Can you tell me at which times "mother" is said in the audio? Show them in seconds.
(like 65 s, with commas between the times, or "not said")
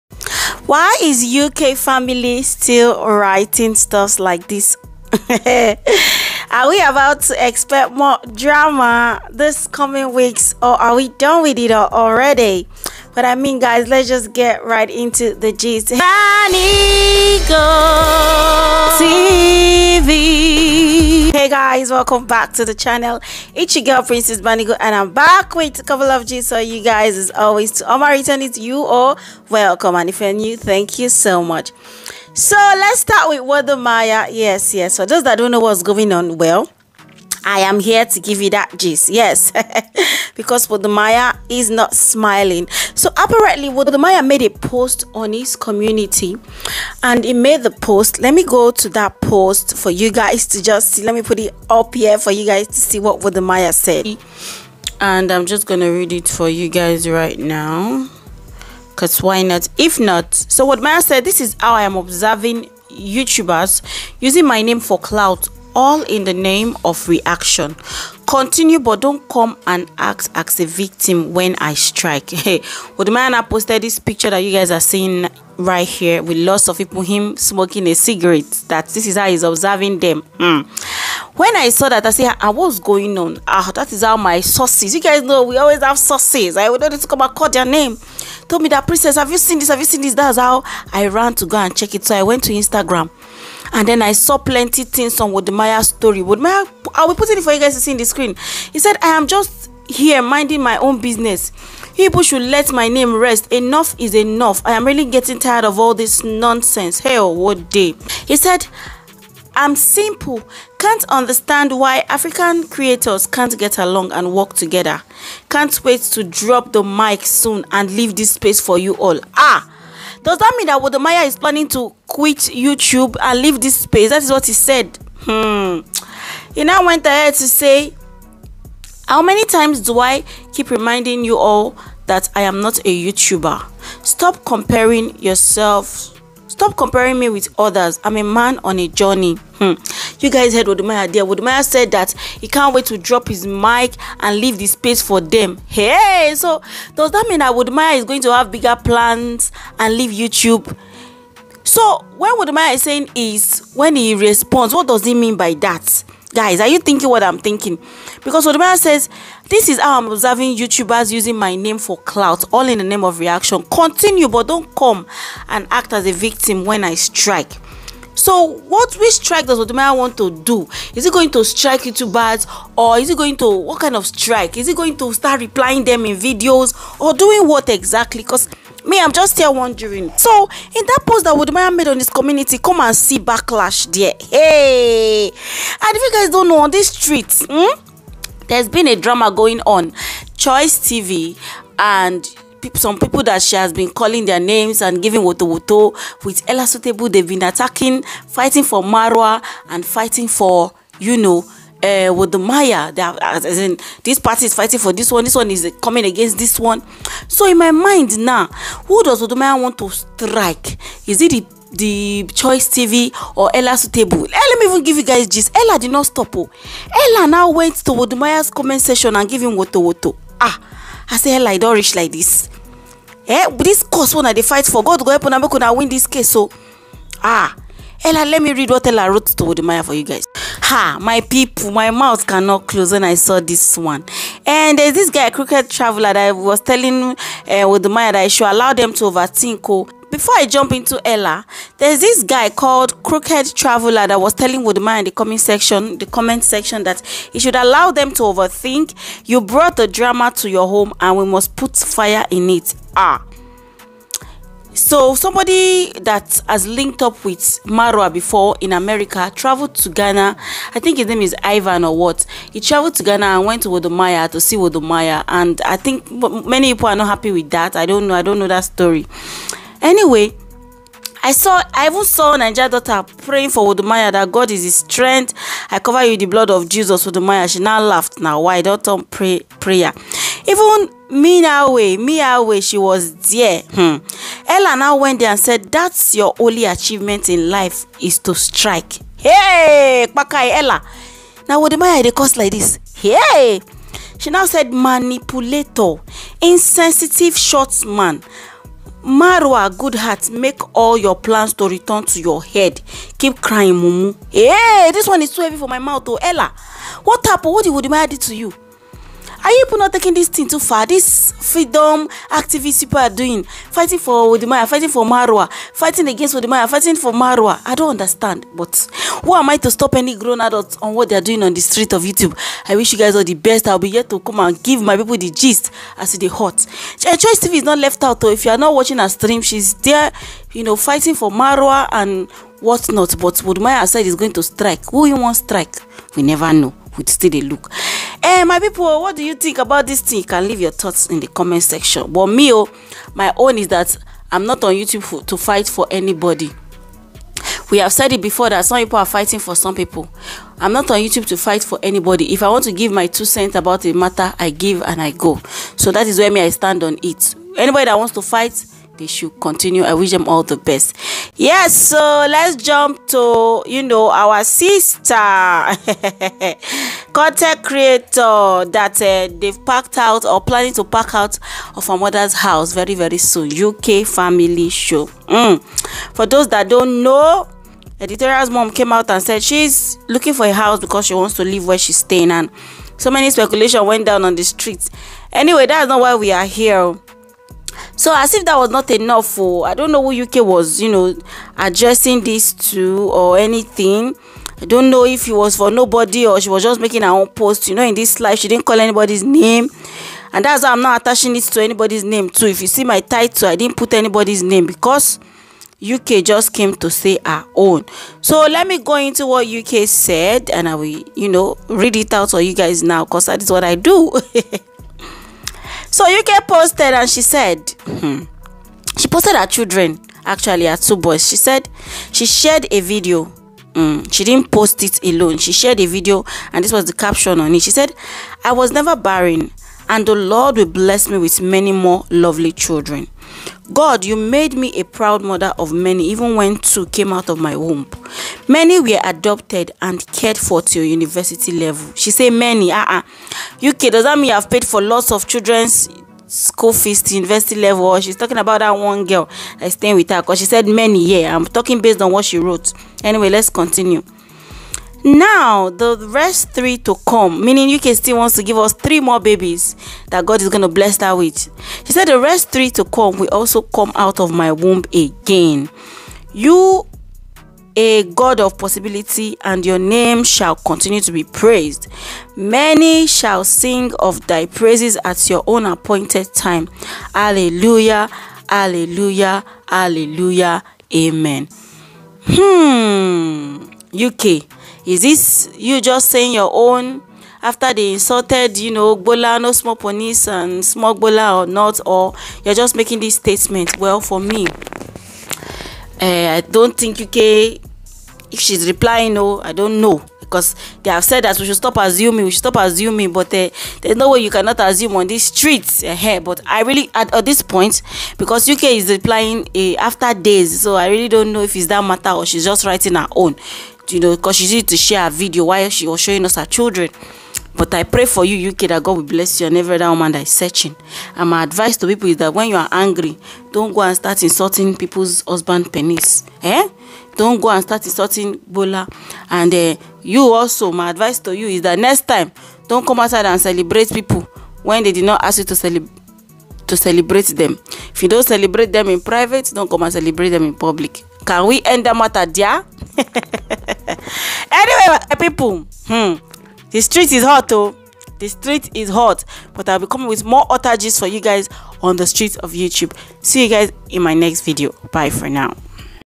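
371 s, 435 s.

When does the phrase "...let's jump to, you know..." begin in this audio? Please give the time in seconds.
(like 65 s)
362 s.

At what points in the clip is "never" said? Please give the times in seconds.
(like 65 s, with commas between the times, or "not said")
336 s, 428 s.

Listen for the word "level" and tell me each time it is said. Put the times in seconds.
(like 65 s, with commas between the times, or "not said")
441 s, 447 s.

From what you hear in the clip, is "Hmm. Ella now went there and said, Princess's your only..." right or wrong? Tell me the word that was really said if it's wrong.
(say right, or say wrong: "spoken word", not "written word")
wrong: "That", not "Princess".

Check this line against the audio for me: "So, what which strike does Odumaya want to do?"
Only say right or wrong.
right.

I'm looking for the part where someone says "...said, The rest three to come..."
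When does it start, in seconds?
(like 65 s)
461 s.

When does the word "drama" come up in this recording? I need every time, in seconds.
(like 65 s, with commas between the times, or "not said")
8 s, 188 s, 249 s.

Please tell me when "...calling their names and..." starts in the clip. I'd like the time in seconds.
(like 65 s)
193 s.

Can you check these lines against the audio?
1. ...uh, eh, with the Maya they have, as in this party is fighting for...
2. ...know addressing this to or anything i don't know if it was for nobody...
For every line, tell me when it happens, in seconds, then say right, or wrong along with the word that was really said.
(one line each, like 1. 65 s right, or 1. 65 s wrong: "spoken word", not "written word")
1. 201 s right
2. 390 s right.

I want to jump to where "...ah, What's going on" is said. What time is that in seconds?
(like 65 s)
82 s.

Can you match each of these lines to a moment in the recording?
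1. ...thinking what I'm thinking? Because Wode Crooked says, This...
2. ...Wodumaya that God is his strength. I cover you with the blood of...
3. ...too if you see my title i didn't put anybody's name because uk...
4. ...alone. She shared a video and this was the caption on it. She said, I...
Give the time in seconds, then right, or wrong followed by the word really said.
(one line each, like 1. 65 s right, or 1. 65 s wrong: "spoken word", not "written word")
1. 156 s wrong: "Maya", not "Crooked"
2. 273 s right
3. 402 s right
4. 425 s right.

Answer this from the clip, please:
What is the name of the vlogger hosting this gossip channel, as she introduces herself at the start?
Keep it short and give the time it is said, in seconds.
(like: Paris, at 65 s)
Princess Banigo, at 24 s.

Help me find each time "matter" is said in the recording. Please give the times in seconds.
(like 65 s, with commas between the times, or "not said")
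353 s, 511 s, 541 s.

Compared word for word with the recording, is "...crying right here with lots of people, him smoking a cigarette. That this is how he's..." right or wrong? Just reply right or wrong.
wrong.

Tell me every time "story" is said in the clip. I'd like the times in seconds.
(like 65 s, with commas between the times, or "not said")
95 s, 268 s.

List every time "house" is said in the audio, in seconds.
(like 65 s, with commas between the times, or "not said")
372 s, 380 s.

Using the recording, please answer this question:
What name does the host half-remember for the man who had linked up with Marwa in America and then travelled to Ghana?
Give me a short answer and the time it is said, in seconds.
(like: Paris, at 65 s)
Ivan, at 261 s.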